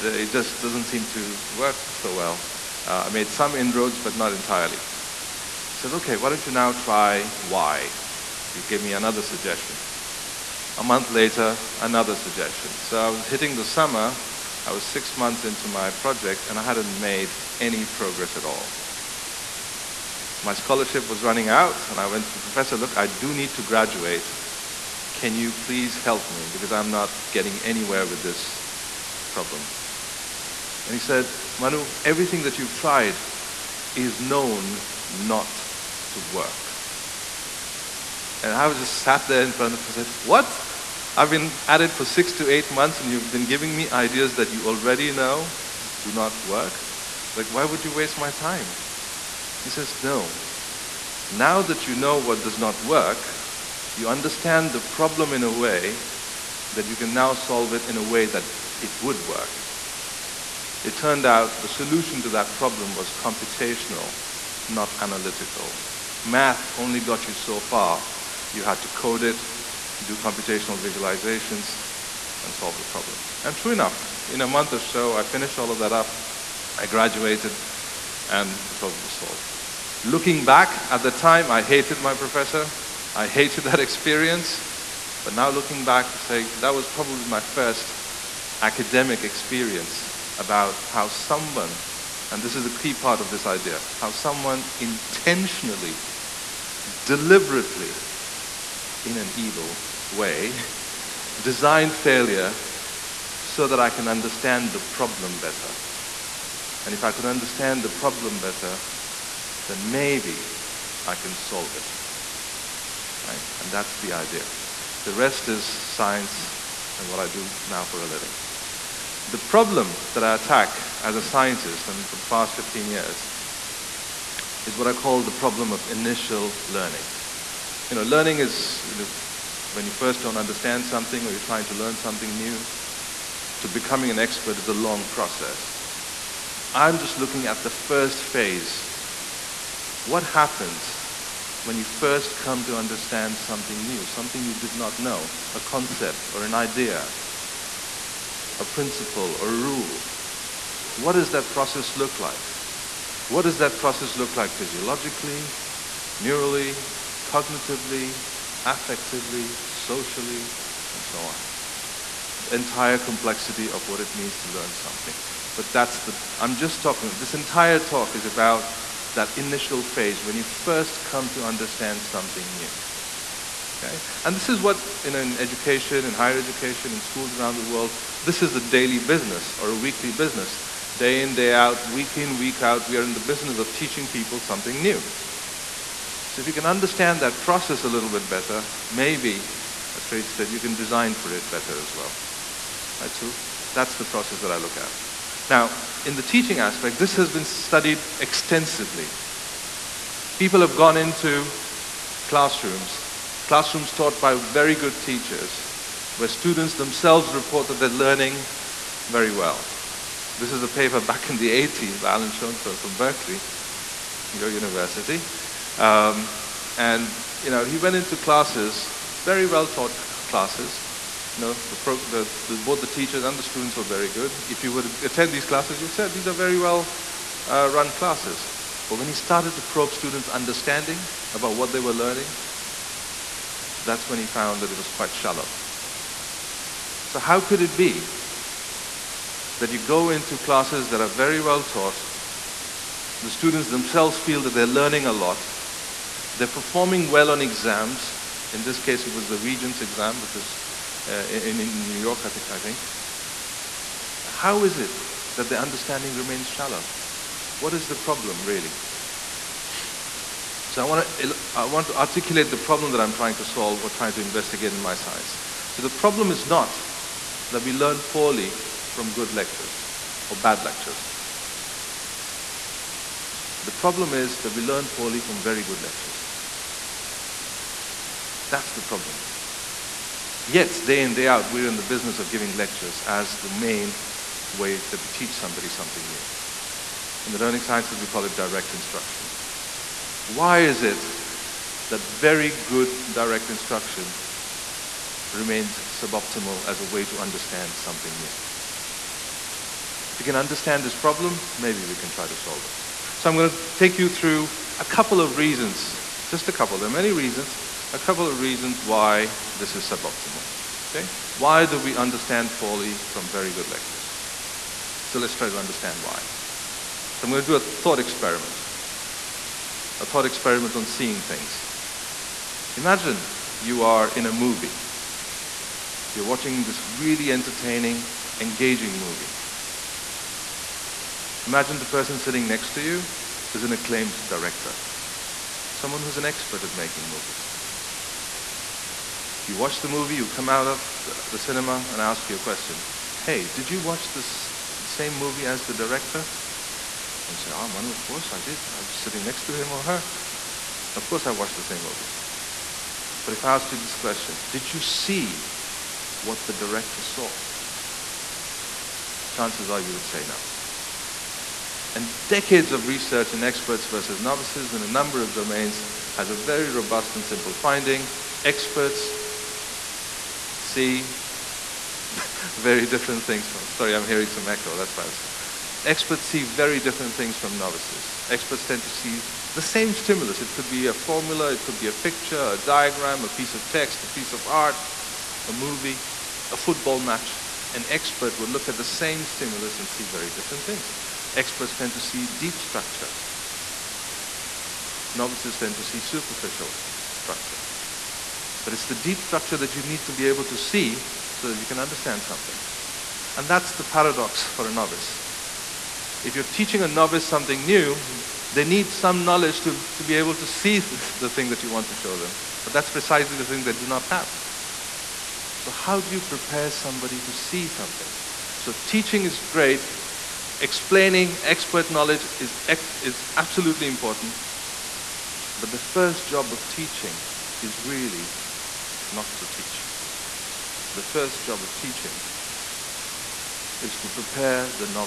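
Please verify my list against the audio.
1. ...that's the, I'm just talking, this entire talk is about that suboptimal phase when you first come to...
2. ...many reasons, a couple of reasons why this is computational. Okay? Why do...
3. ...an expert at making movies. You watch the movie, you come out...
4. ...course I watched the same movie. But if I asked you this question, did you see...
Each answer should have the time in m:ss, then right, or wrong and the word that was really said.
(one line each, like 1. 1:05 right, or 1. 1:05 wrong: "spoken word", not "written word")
1. 2:45 wrong: "initial", not "suboptimal"
2. 5:06 wrong: "suboptimal", not "computational"
3. 5:36 right
4. 5:51 right.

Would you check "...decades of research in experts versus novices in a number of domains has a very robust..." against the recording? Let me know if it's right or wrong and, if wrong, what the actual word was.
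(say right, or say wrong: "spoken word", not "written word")
right.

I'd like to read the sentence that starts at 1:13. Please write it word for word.
And true enough, in a month or so, I finished all of that up, I graduated, and the problem was solved.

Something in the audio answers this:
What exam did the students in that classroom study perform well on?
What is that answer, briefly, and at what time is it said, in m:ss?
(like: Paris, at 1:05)
Regents exam, at 4:09.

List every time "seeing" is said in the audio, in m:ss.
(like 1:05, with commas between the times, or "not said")
5:20.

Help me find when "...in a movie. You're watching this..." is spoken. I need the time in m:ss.
5:24.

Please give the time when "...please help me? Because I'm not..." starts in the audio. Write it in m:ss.
0:25.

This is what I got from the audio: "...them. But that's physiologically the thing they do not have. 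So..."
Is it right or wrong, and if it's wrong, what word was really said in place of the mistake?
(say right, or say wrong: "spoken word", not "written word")
wrong: "precisely", not "physiologically".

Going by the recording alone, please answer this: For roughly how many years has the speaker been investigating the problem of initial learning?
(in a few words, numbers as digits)
15.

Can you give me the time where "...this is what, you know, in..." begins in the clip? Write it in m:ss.
2:54.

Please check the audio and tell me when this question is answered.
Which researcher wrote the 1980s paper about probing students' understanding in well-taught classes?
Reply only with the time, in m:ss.
3:32.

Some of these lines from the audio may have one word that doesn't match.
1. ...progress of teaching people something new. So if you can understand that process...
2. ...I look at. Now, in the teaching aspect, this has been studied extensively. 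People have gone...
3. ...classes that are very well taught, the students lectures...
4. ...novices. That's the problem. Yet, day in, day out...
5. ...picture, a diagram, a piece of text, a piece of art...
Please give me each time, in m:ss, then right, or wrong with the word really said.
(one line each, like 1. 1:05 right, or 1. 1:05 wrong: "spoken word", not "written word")
1. 3:03 wrong: "business", not "progress"
2. 3:14 right
3. 4:00 wrong: "themselves", not "lectures"
4. 4:35 wrong: "lectures", not "novices"
5. 6:21 right.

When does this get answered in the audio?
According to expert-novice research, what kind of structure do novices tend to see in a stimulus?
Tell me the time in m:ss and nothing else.
6:36.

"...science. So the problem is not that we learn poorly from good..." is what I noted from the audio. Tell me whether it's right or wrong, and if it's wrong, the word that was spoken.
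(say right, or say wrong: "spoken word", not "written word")
right.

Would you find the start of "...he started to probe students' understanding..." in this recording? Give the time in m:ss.
3:49.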